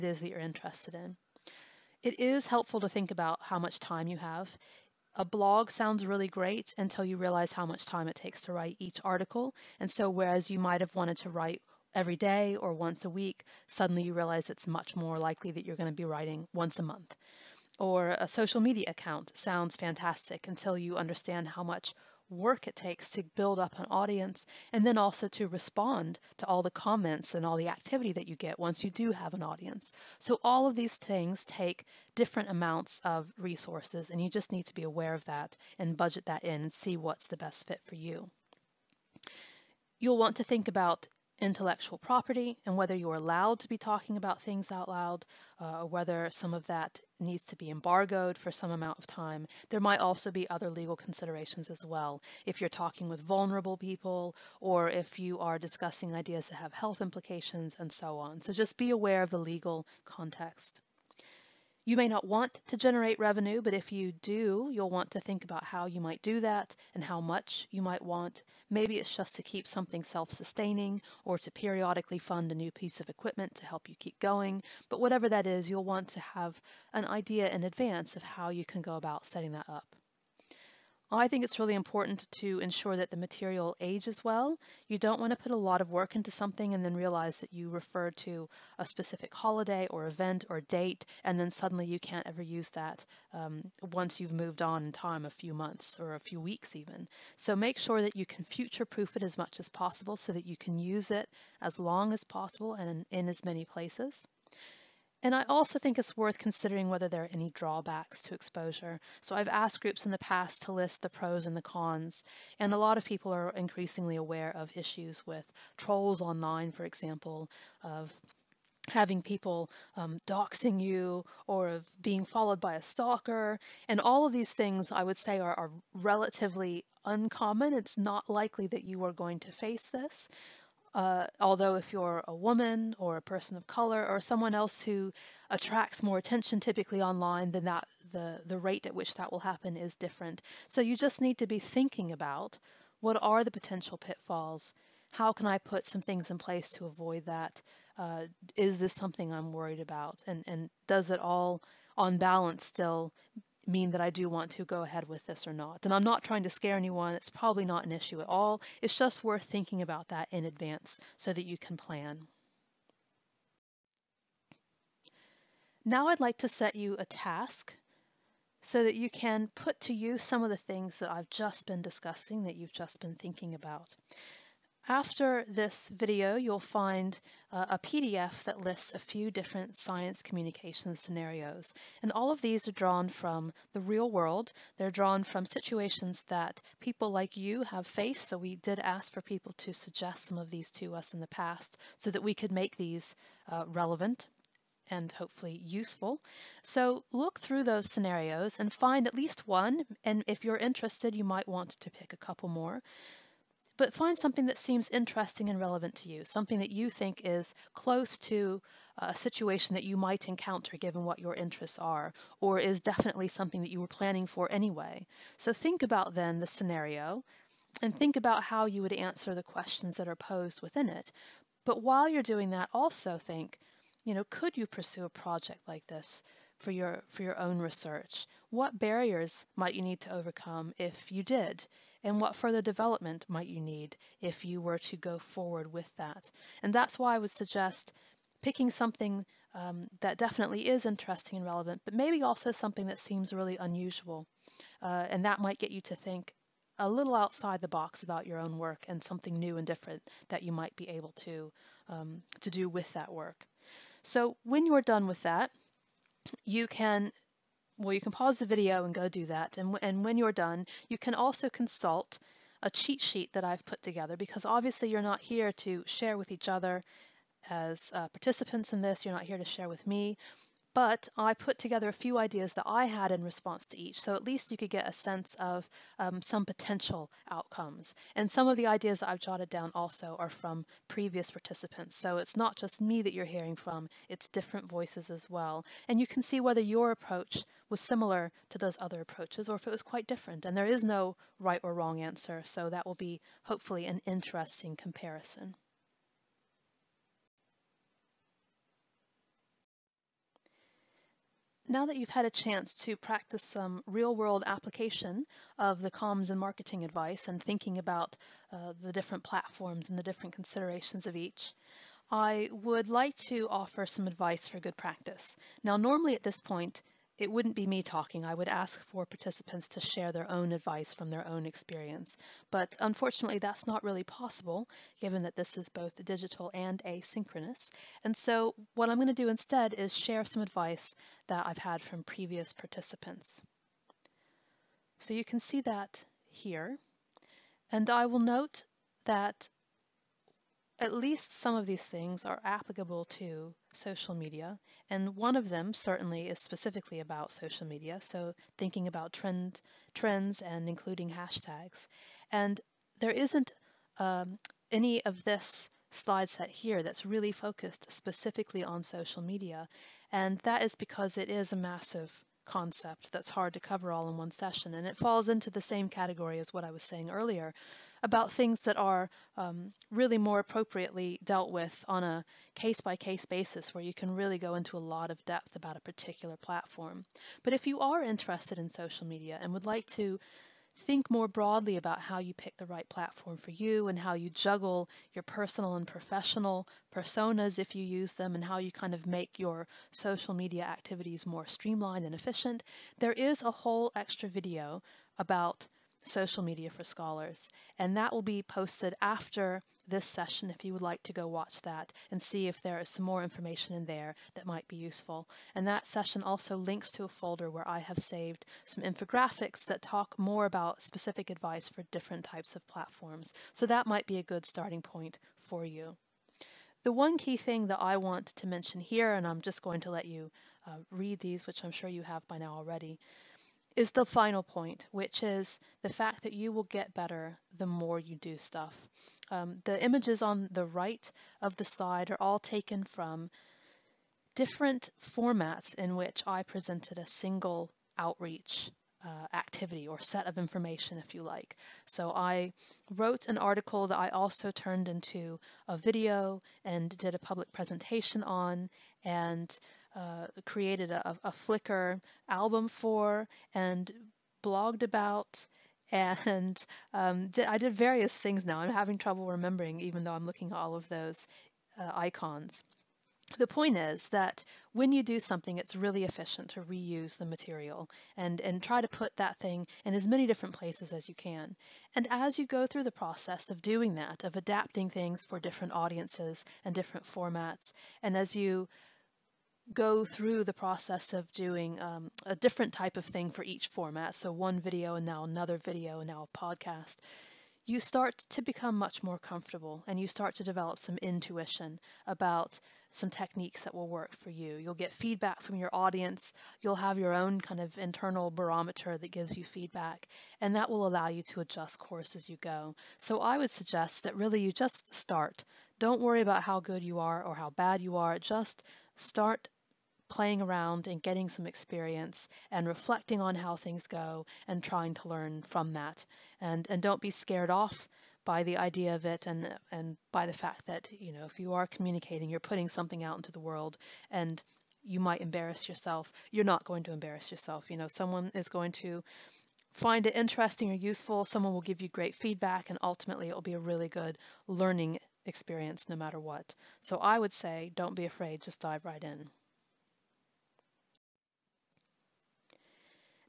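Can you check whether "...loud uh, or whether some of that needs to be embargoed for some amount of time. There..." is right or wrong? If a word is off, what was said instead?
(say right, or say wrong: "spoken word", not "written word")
right.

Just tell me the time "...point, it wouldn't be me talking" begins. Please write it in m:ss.
5:16.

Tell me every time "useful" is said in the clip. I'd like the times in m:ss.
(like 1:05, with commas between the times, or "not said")
3:15, 6:44, 8:50.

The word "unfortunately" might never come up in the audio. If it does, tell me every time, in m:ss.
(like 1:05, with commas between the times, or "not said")
5:22.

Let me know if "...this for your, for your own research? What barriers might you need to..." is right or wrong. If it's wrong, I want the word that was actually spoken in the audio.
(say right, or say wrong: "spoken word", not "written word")
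right.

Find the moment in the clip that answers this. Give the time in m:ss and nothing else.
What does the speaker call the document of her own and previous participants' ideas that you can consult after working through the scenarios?
4:22.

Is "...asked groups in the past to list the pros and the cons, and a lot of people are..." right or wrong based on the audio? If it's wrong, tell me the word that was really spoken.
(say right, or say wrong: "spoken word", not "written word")
right.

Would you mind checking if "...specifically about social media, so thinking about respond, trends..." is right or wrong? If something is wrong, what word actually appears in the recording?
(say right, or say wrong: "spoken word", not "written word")
wrong: "trend", not "respond".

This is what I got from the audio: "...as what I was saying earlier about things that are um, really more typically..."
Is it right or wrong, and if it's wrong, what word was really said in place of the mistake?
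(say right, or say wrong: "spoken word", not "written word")
wrong: "appropriately", not "typically".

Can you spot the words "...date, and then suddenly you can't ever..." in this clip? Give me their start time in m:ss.
1:30.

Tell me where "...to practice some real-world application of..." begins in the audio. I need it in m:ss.
5:02.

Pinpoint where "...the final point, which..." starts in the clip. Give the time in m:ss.
7:03.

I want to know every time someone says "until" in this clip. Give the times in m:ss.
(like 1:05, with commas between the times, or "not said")
0:06, 0:20.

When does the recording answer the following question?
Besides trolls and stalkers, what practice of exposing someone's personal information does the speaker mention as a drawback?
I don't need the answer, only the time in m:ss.
2:00.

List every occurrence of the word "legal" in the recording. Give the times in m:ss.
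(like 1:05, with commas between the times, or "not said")
0:50, 0:59.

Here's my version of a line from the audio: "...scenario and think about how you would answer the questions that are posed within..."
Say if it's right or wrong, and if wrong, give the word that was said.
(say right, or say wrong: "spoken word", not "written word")
right.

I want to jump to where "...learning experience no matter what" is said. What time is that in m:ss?
8:54.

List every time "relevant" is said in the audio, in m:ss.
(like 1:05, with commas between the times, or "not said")
3:13, 3:25, 4:01.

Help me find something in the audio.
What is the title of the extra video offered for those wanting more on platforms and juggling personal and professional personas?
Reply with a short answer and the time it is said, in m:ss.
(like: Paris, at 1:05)
Social Media for Scholars, at 6:36.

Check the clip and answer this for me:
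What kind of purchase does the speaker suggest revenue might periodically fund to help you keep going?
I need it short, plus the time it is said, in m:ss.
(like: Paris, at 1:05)
a new piece of equipment, at 1:12.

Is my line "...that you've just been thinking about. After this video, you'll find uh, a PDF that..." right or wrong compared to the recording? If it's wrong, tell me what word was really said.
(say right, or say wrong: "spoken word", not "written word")
right.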